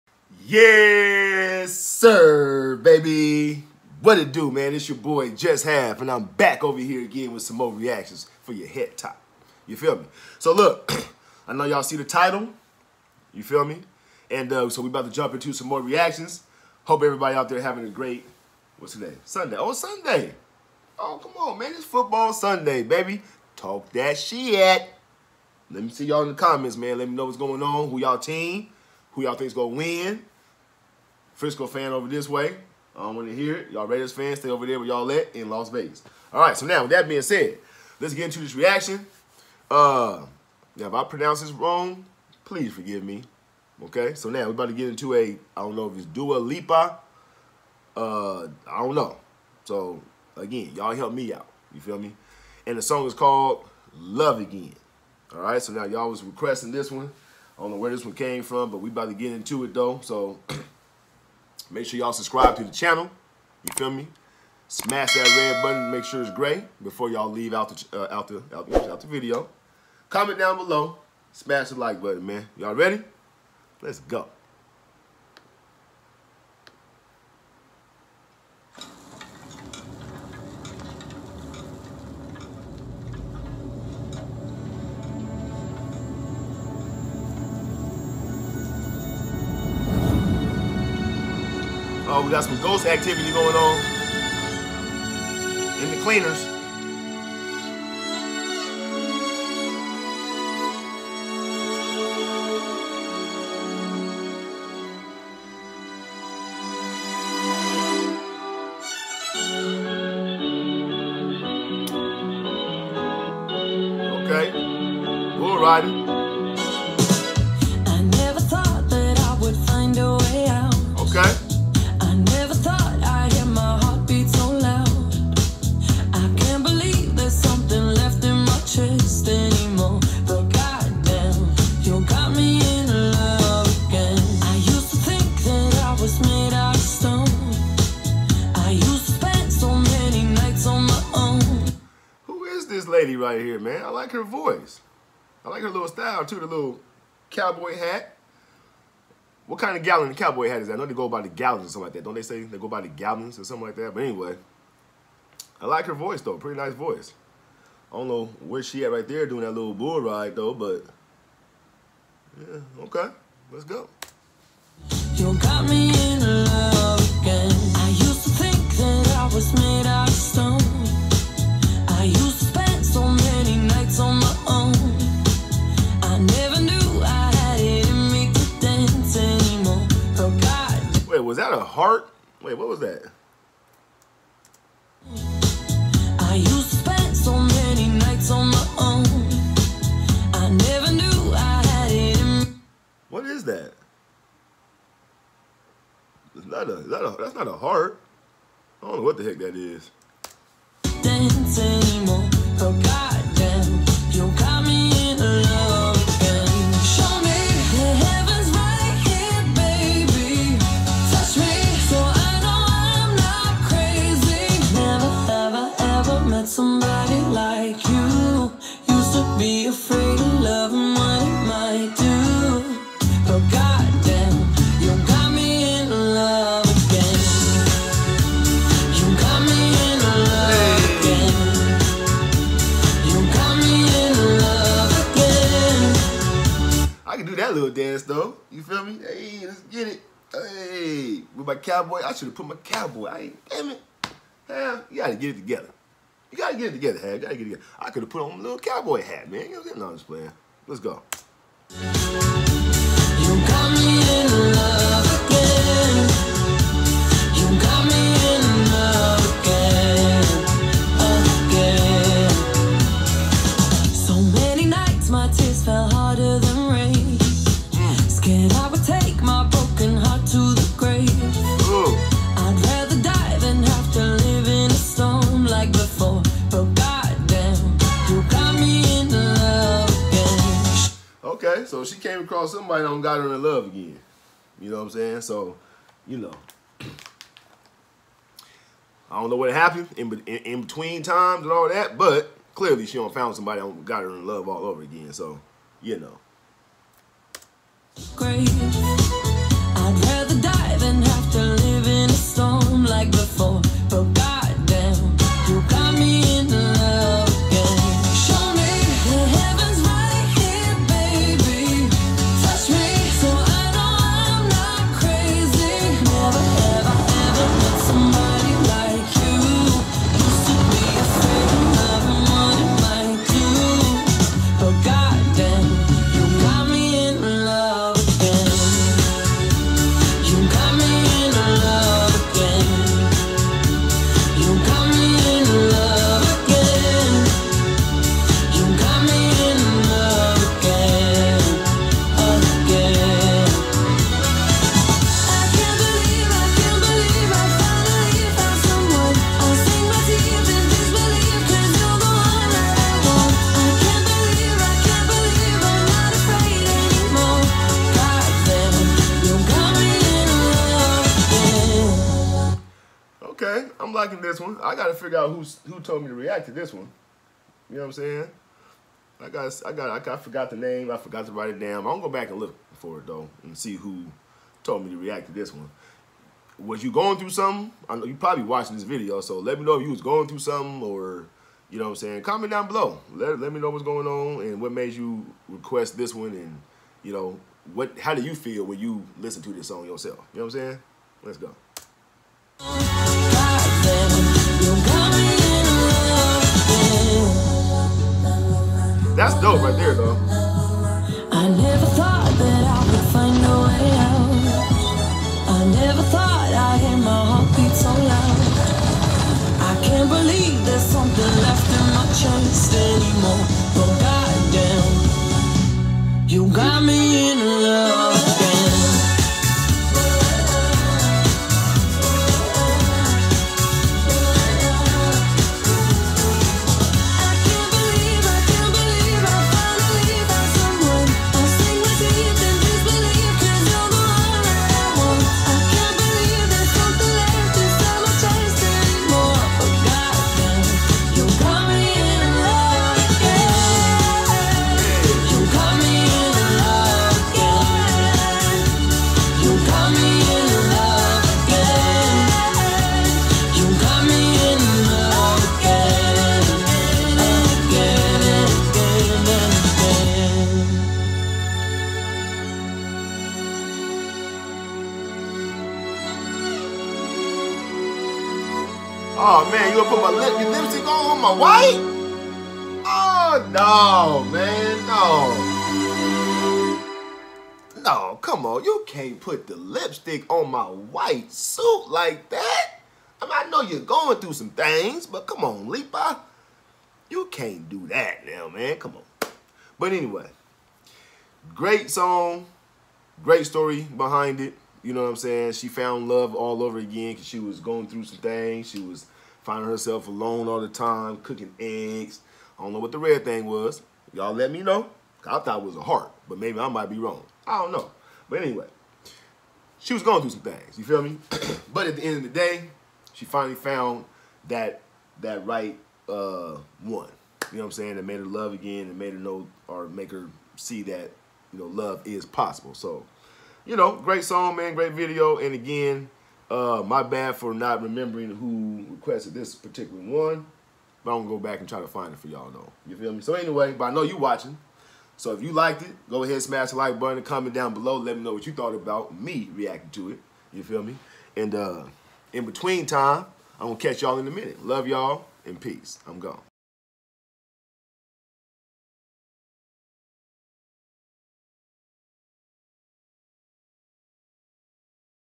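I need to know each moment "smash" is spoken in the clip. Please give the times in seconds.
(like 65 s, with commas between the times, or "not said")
64 s, 71 s, 536 s.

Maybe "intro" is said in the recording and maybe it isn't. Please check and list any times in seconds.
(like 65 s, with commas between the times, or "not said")
not said.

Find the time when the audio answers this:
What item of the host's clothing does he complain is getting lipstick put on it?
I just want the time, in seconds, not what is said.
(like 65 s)
480 s.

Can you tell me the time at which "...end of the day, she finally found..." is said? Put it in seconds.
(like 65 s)
512 s.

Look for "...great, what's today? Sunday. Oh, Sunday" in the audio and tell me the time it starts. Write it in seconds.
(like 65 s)
17 s.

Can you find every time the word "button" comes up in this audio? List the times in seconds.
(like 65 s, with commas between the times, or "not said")
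65 s, 72 s, 536 s.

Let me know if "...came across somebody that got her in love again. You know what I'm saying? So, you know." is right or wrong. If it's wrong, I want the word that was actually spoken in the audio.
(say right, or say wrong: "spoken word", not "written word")
right.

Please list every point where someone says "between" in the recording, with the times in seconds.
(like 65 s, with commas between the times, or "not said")
290 s, 542 s.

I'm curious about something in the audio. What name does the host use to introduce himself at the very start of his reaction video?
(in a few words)
Just Half.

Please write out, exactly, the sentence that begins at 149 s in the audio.
What kind of gallon the cowboy hat is that?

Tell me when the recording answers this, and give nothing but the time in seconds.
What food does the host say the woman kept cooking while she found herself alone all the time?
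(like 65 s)
501 s.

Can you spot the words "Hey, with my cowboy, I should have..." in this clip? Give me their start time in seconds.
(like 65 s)
240 s.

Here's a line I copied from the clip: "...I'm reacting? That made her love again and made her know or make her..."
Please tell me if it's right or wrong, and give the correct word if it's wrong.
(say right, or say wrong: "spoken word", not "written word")
wrong: "saying", not "reacting".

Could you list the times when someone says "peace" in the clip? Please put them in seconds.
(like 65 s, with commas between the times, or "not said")
545 s.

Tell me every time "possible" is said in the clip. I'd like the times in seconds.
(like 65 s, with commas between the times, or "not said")
522 s.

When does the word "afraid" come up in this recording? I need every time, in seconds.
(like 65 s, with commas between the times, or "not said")
not said.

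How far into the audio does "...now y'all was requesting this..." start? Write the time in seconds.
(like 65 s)
55 s.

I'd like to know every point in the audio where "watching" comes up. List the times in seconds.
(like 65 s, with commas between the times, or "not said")
378 s, 534 s.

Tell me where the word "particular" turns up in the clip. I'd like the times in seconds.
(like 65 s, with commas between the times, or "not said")
529 s.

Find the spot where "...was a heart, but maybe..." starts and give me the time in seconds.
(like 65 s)
505 s.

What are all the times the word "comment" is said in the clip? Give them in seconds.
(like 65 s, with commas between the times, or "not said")
26 s, 70 s, 382 s, 537 s.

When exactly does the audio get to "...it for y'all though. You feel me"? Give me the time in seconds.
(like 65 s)
532 s.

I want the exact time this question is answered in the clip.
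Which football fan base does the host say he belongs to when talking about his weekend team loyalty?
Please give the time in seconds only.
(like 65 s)
31 s.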